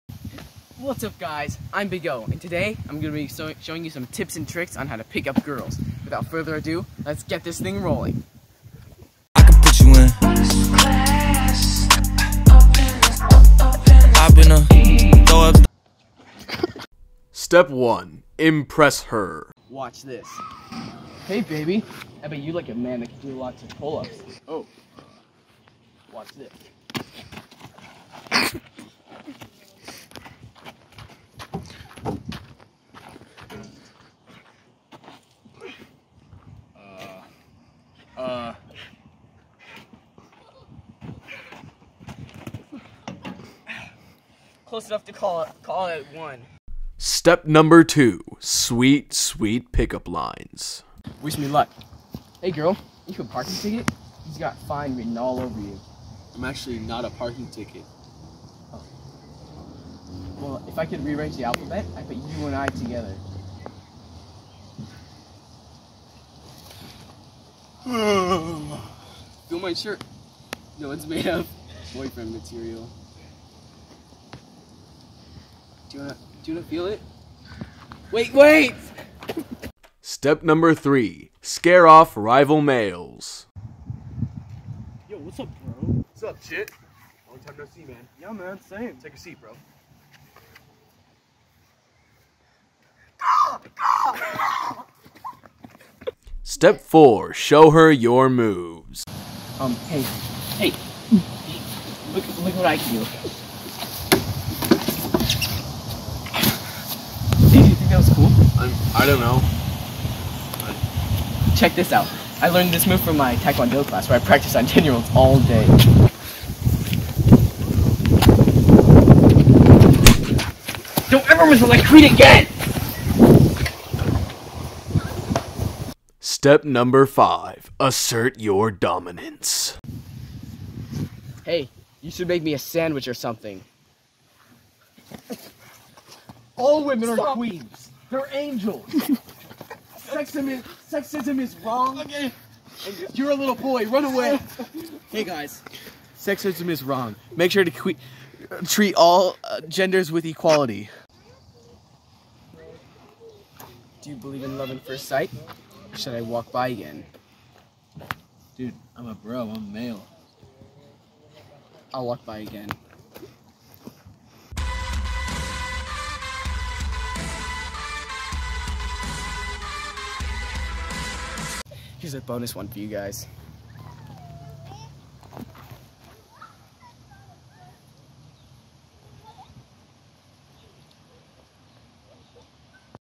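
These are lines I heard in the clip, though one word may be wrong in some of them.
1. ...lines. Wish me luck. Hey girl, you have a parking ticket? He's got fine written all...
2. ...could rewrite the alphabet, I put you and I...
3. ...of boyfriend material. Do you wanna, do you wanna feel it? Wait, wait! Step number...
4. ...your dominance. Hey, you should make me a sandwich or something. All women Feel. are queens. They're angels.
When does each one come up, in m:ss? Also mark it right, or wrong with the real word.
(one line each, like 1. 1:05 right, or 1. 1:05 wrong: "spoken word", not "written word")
1. 0:50 right
2. 1:00 right
3. 1:11 right
4. 2:08 wrong: "Stop", not "Feel".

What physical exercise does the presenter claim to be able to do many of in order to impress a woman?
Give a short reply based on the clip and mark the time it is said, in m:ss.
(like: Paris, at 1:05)
Pull-ups, at 0:23.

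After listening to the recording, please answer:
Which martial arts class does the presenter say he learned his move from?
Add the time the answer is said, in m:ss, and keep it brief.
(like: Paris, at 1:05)
Taekwondo, at 1:53.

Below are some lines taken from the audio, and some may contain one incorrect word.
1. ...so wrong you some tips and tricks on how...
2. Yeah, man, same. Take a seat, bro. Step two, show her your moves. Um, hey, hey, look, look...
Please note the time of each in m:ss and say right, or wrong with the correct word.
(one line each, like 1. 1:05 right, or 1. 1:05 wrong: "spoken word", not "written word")
1. 0:03 wrong: "showing", not "wrong"
2. 1:28 wrong: "four", not "two".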